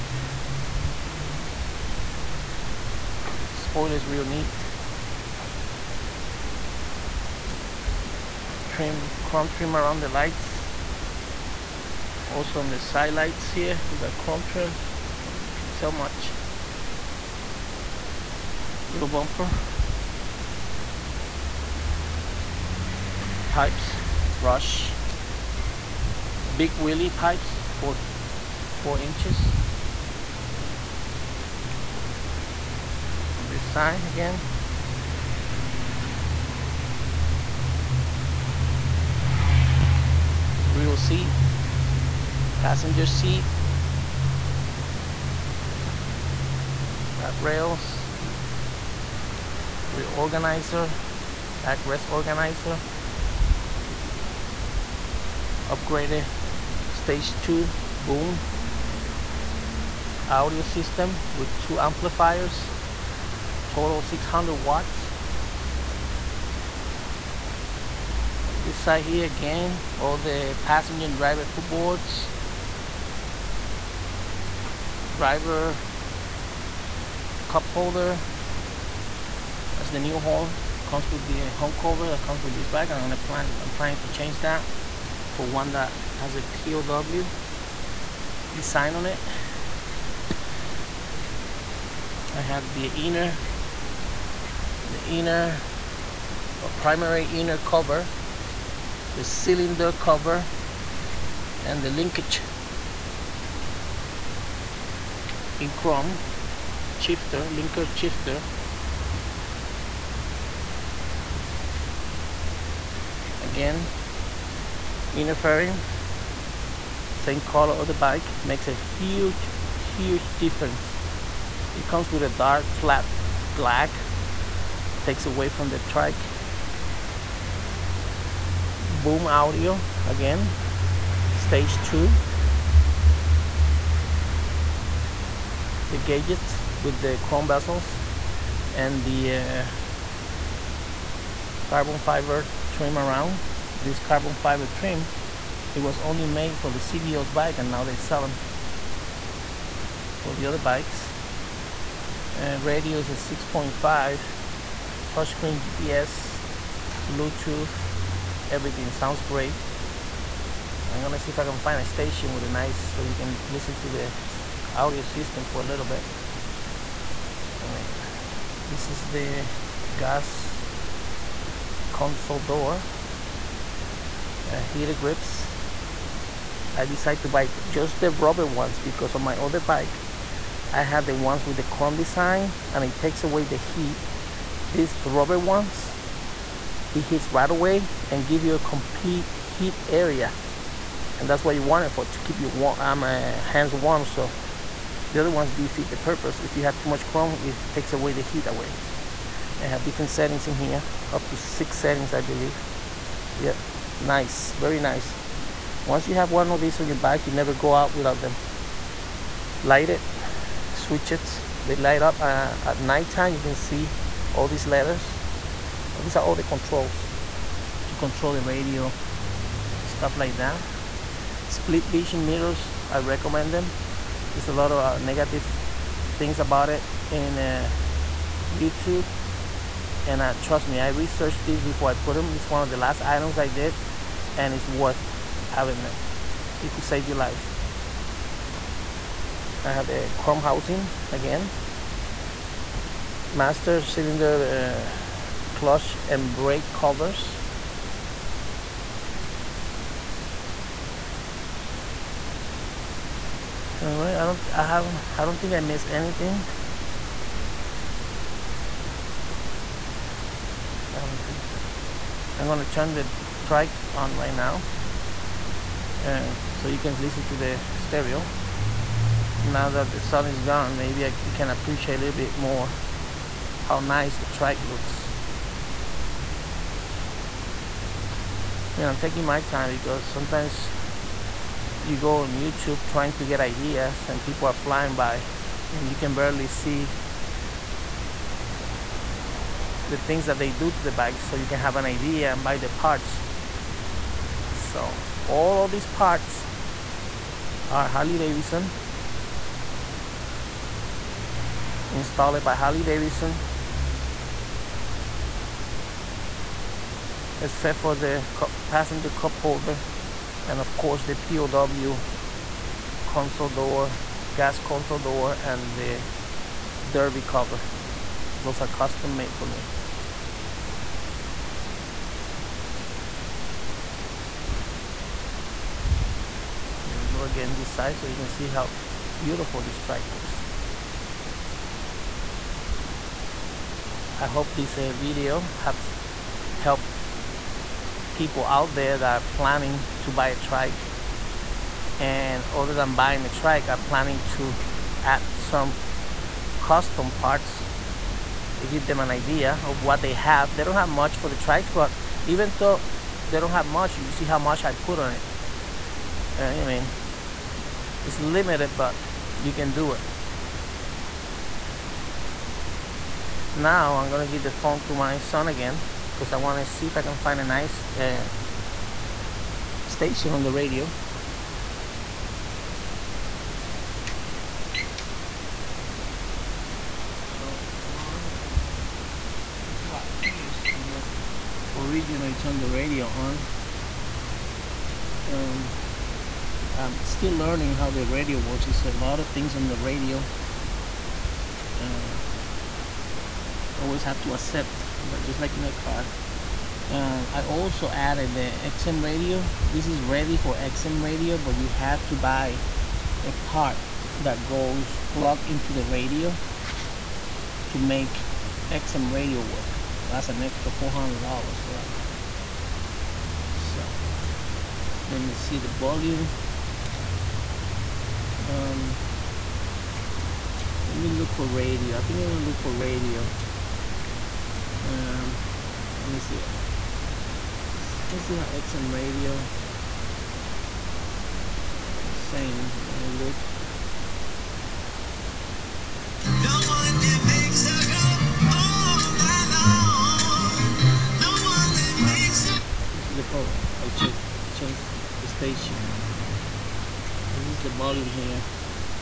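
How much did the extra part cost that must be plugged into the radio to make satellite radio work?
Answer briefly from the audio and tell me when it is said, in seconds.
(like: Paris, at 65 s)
$400, at 410 s.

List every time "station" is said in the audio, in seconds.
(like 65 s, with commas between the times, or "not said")
161 s, 369 s, 445 s.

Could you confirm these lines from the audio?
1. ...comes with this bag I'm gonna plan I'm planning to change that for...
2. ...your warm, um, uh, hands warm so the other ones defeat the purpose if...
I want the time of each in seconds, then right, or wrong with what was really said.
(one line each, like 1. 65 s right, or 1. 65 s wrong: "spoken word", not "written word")
1. 82 s right
2. 192 s right.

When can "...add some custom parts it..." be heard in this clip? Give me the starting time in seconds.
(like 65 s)
345 s.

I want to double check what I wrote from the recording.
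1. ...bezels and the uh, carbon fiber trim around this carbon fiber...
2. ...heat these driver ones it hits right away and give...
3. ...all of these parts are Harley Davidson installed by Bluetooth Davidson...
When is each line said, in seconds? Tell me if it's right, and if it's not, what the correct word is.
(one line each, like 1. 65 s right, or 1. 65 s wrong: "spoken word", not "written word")
1. 137 s right
2. 183 s wrong: "rubber", not "driver"
3. 295 s wrong: "Harley", not "Bluetooth".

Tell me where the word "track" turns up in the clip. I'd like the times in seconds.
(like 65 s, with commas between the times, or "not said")
263 s, 274 s, 329 s.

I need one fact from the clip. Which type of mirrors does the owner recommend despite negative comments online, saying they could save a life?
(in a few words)
split vision mirrors.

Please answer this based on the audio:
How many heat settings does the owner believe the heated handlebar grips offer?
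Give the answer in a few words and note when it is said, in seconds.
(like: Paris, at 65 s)
6, at 201 s.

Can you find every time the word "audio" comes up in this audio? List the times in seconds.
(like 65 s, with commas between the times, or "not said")
60 s, 129 s, 164 s.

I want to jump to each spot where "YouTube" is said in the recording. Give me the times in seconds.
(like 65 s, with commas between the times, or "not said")
228 s, 282 s.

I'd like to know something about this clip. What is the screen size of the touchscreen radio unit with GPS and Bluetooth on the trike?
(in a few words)
6.5.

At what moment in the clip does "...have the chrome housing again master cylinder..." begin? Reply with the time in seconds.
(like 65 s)
239 s.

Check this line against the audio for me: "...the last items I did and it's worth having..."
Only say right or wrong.
right.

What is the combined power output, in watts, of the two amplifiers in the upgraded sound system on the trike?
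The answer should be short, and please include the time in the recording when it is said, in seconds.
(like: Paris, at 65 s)
600 watts, at 64 s.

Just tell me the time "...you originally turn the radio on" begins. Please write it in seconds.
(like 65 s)
380 s.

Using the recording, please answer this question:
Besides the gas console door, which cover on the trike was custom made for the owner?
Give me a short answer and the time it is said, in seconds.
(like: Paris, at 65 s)
derby cover, at 316 s.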